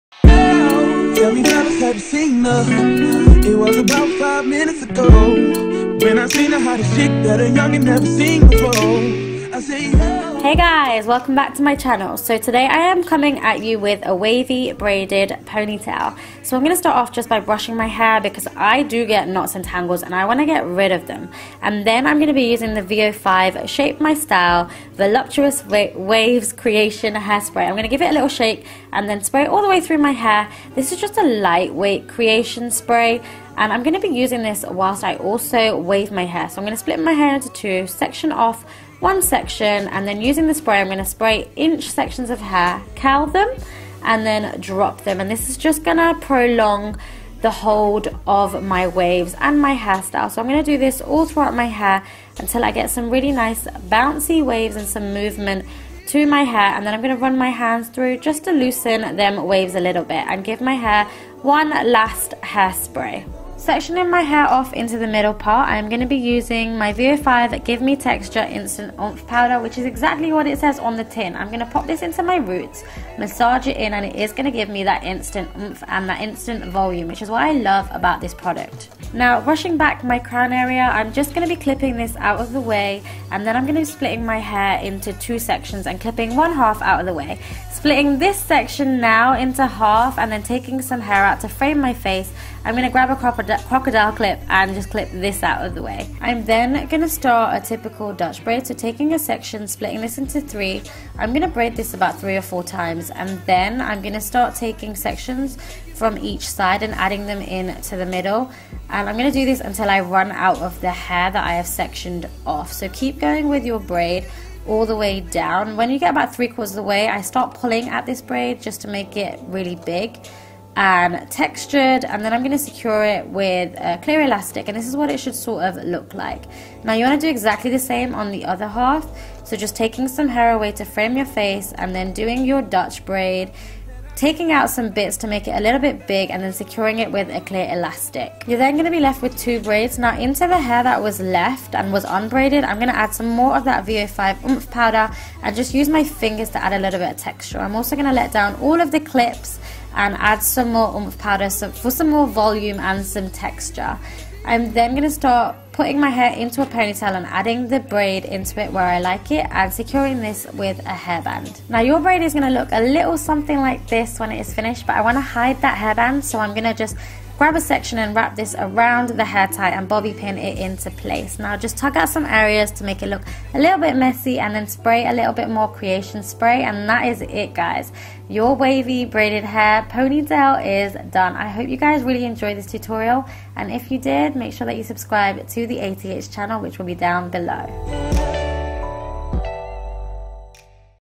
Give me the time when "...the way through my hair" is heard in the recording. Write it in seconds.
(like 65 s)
29 s.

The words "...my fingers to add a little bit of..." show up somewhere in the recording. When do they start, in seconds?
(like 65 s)
145 s.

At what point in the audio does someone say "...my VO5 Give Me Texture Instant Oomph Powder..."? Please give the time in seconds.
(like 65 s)
66 s.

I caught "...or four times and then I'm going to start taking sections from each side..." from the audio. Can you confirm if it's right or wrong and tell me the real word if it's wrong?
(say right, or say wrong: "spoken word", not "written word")
right.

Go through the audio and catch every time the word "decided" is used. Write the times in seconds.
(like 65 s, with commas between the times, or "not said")
not said.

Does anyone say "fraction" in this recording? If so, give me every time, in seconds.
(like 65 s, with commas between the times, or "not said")
not said.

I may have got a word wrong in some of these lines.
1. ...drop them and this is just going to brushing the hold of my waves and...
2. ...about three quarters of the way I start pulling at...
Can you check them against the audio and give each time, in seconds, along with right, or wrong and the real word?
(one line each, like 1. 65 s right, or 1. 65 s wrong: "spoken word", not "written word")
1. 44 s wrong: "prolong", not "brushing"
2. 116 s right.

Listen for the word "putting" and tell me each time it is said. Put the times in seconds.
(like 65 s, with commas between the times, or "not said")
155 s.